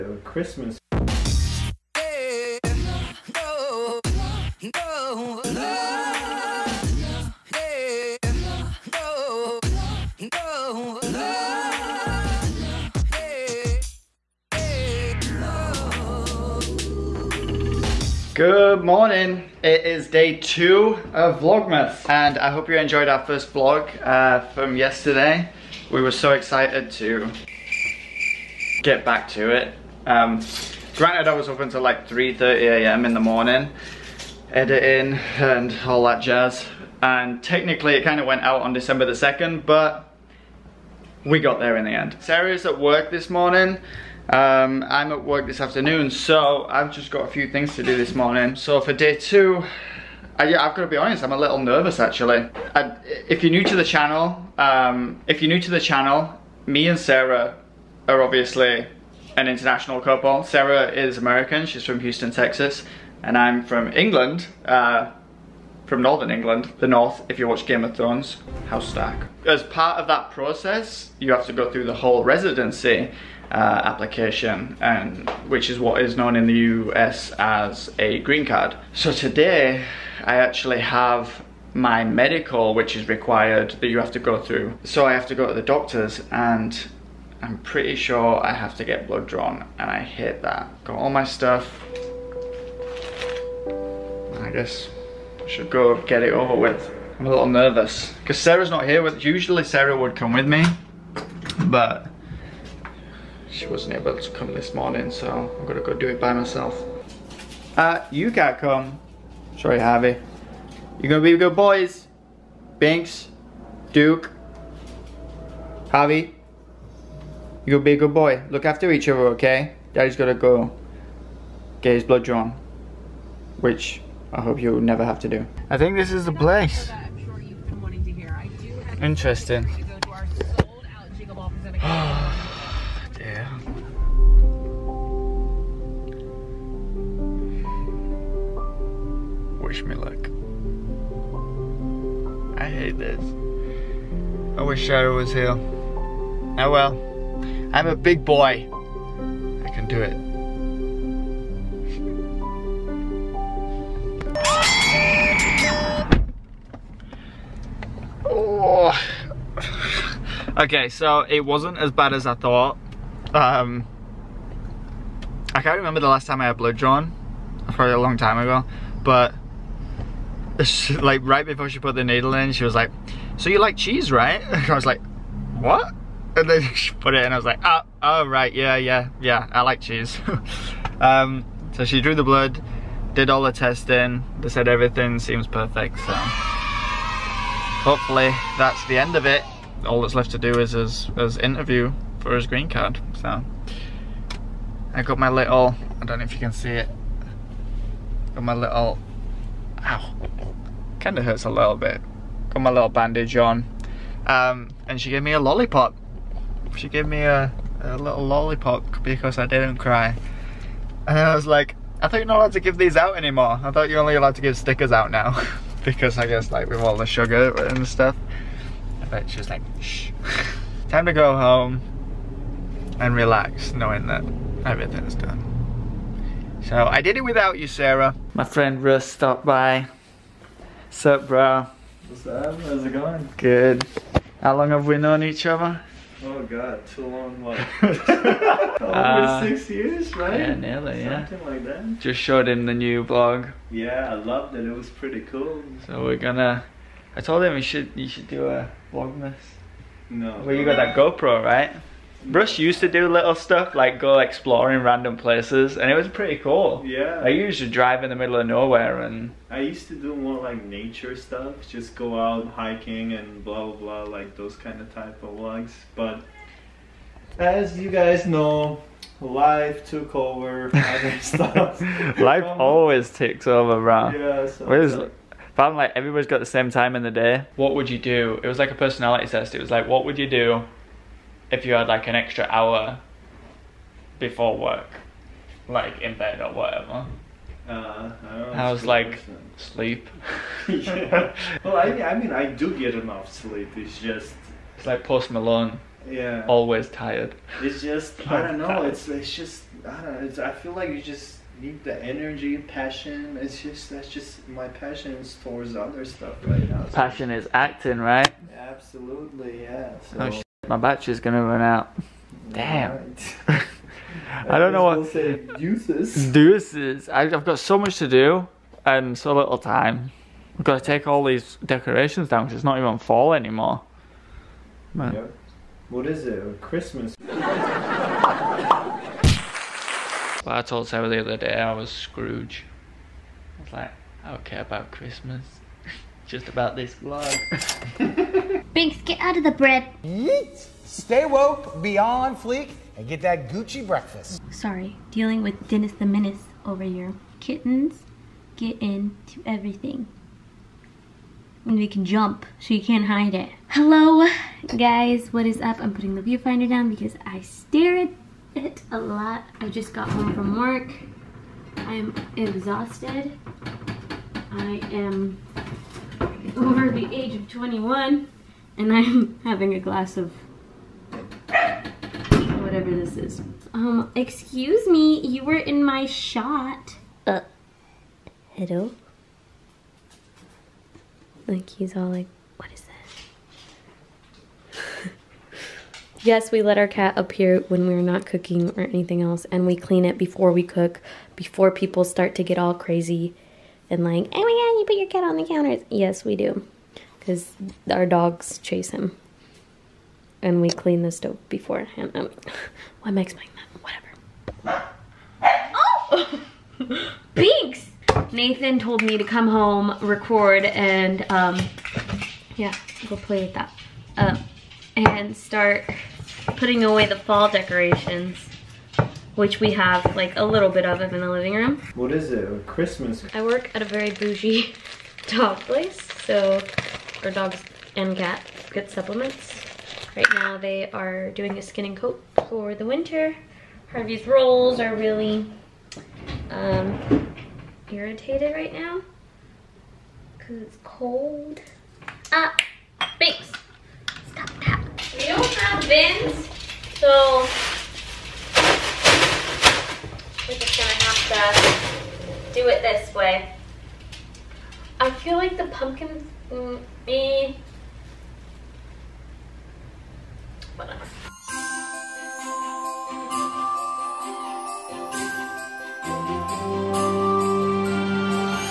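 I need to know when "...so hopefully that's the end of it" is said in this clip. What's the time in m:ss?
3:05.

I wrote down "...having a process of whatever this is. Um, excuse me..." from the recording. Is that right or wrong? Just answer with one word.
wrong.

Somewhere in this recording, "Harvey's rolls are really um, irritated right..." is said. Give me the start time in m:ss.
7:13.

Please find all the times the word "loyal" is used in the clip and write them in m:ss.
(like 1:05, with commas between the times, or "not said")
not said.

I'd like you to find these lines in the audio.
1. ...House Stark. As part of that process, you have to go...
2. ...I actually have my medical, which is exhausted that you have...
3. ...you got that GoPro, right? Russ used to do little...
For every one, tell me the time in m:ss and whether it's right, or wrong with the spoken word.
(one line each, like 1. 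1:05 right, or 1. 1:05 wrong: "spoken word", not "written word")
1. 1:08 right
2. 1:20 wrong: "required", not "exhausted"
3. 4:10 right.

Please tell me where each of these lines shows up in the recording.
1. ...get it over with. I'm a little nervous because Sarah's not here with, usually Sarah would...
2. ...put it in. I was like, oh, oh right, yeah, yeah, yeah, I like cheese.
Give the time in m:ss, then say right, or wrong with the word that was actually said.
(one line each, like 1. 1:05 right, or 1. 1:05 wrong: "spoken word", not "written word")
1. 1:36 right
2. 2:56 right.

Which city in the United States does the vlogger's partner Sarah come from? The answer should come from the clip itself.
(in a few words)
Houston.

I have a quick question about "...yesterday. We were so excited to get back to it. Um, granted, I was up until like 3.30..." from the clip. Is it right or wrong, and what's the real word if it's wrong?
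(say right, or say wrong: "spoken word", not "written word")
right.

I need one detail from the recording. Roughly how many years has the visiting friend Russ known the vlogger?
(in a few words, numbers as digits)
6.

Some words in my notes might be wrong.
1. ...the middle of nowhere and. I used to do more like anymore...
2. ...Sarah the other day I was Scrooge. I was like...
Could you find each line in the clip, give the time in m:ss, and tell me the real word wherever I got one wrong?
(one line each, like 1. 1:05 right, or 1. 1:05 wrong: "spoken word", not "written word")
1. 4:18 wrong: "nature", not "anymore"
2. 5:30 right.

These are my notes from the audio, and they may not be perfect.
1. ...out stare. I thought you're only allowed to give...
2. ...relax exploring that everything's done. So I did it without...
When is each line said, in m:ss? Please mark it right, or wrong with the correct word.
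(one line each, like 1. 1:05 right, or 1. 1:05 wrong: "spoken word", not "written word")
1. 3:32 wrong: "anymore", not "stare"
2. 3:43 wrong: "knowing", not "exploring".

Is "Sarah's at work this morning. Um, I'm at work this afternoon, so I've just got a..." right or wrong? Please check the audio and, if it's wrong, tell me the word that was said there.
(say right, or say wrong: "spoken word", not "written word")
right.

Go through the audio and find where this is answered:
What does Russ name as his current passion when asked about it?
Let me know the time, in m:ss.
5:07.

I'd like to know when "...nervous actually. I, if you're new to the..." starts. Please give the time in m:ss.
0:51.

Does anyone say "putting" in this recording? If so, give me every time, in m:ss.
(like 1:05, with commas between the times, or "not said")
5:55, 6:56.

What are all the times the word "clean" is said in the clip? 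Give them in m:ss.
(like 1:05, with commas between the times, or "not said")
6:29, 6:40.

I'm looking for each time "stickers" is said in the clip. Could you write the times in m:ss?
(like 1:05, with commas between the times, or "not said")
3:34.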